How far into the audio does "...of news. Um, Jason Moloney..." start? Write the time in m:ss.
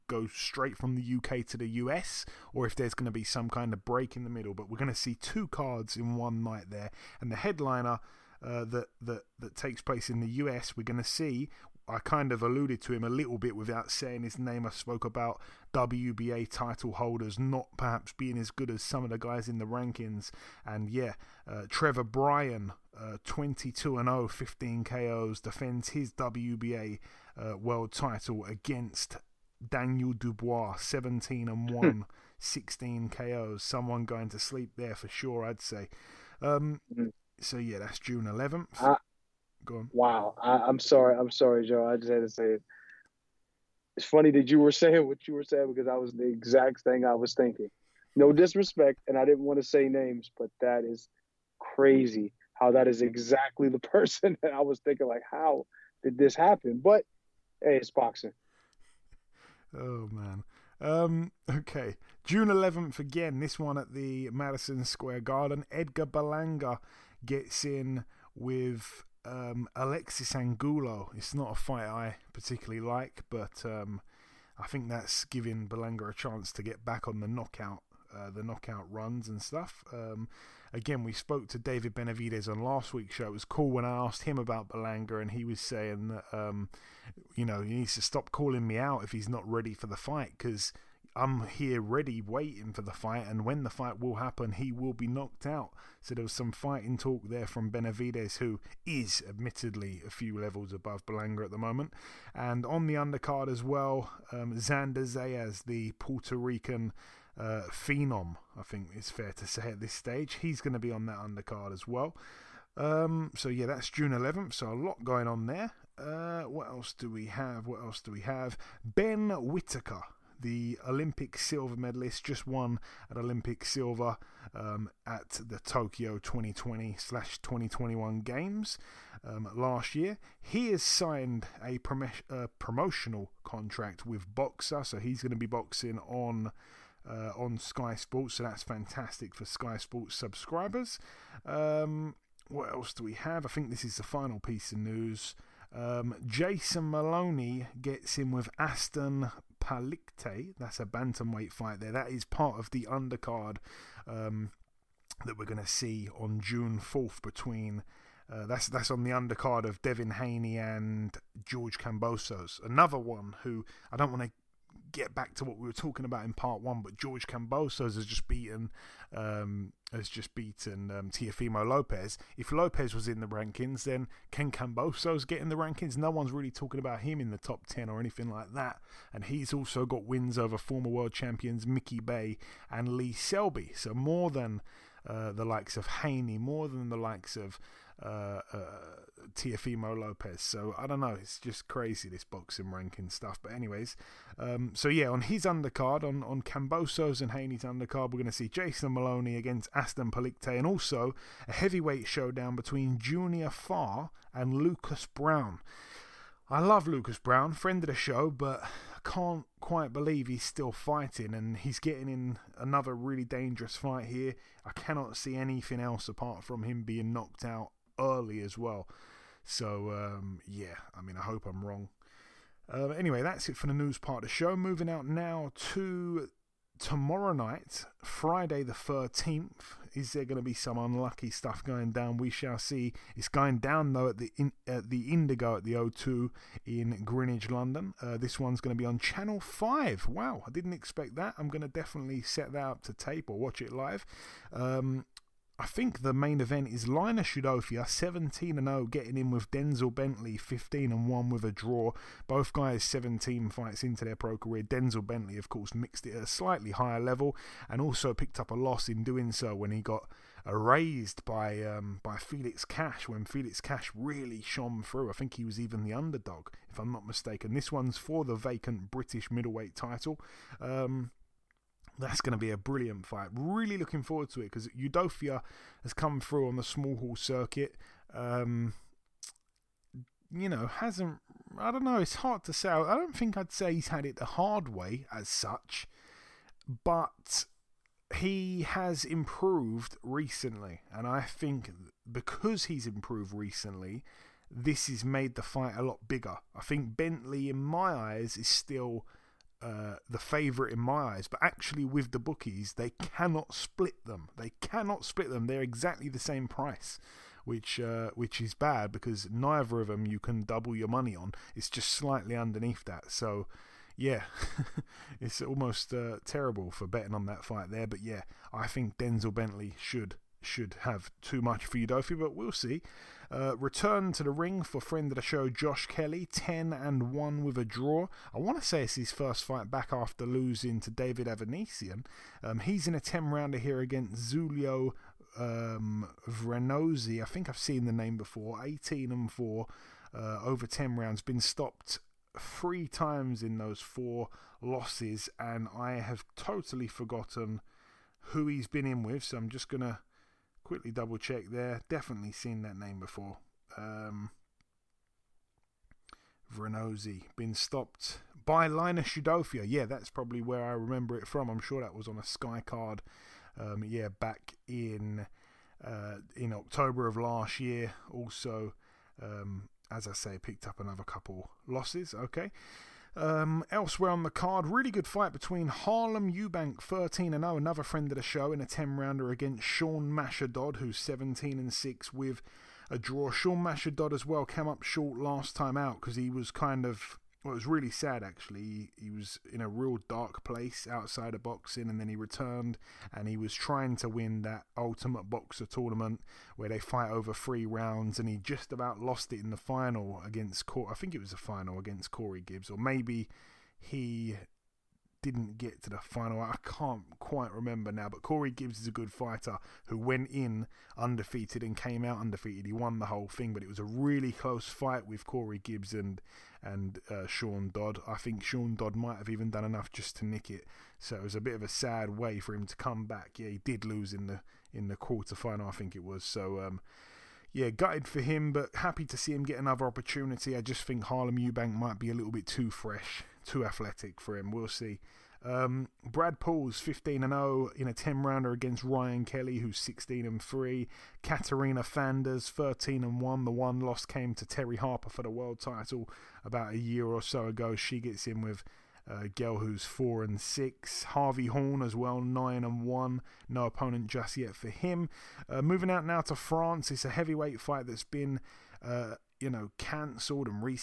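2:24.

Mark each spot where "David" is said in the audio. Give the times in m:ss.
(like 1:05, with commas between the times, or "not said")
1:21, 5:30.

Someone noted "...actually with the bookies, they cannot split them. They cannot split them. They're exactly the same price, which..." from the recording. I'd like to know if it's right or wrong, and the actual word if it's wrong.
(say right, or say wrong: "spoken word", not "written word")
right.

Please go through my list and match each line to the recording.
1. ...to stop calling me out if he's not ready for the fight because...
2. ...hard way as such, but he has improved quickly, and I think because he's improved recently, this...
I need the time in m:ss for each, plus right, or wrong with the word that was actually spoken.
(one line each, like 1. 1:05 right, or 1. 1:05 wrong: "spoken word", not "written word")
1. 1:27 right
2. 4:44 wrong: "recently", not "quickly".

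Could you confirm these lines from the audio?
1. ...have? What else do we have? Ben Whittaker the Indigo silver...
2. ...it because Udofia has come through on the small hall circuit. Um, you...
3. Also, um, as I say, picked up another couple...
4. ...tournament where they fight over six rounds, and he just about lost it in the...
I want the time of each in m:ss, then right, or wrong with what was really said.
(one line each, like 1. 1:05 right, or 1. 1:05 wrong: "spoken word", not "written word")
1. 1:57 wrong: "Olympic", not "Indigo"
2. 4:34 right
3. 6:08 right
4. 6:35 wrong: "three", not "six".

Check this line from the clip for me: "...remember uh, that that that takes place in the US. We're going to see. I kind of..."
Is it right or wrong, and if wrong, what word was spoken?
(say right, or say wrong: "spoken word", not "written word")
wrong: "headliner", not "remember".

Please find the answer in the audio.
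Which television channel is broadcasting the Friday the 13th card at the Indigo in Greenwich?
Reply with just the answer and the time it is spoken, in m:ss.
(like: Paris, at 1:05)
Channel 5, at 3:58.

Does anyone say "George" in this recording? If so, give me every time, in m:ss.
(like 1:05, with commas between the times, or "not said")
2:41, 2:46.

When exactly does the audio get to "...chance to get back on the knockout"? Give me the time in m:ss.
1:16.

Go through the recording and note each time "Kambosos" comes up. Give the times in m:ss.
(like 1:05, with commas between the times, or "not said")
2:41, 2:47, 2:54, 3:16.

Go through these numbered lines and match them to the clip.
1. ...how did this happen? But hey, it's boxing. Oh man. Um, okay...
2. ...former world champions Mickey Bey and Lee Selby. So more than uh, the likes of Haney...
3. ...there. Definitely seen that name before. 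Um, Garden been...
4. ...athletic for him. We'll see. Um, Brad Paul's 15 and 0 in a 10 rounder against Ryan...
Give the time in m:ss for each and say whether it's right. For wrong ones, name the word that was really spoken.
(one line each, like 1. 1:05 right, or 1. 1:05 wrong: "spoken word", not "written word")
1. 0:55 right
2. 3:00 right
3. 5:51 wrong: "Vrenozzi", not "Garden"
4. 7:13 right.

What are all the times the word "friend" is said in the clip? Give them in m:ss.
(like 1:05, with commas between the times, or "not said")
3:27, 5:24, 6:17.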